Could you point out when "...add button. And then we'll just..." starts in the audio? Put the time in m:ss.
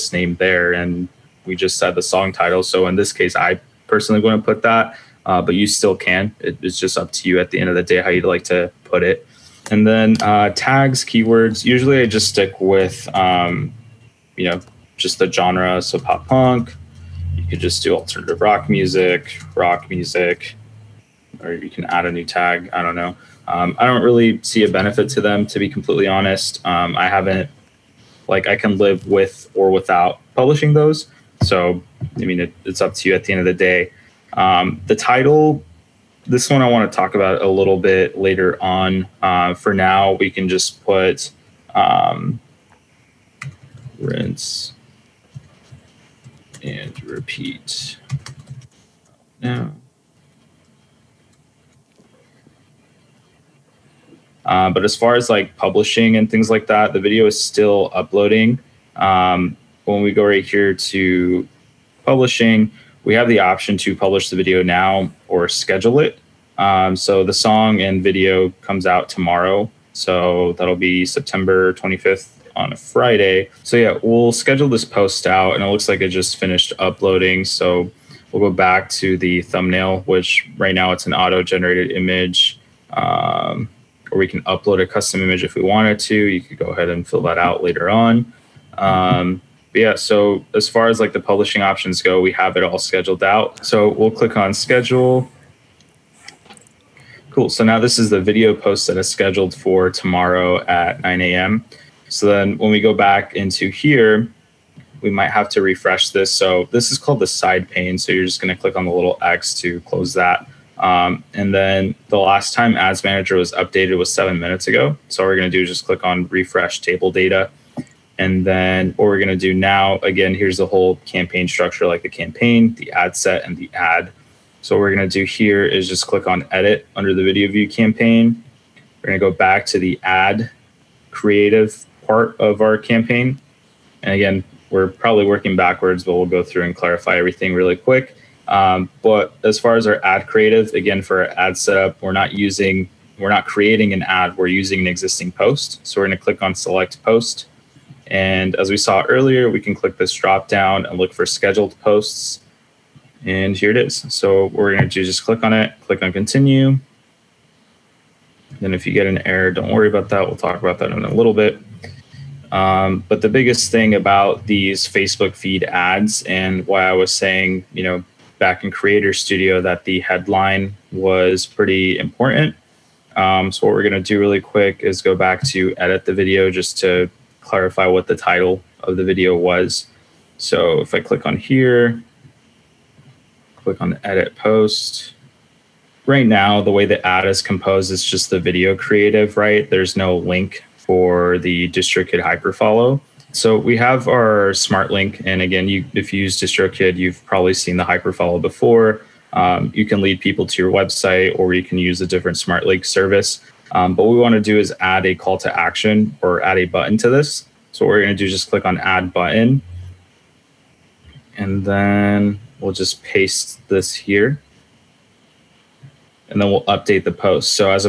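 3:28.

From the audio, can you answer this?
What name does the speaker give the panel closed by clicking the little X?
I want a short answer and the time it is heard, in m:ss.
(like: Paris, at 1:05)
side pane, at 1:47.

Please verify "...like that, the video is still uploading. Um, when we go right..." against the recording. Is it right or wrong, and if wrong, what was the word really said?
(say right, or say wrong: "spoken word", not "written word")
right.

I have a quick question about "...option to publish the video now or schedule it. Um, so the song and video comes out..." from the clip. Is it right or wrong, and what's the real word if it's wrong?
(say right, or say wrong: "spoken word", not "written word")
right.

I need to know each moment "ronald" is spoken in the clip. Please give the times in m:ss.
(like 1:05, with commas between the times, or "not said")
not said.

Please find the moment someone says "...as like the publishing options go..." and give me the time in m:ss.
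1:30.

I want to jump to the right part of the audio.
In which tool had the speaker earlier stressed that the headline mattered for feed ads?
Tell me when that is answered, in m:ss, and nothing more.
2:48.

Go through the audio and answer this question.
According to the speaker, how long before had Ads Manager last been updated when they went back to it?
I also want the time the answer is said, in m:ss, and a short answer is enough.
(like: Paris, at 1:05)
7 minutes, at 1:54.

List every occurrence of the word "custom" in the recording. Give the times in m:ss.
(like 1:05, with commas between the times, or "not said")
1:24.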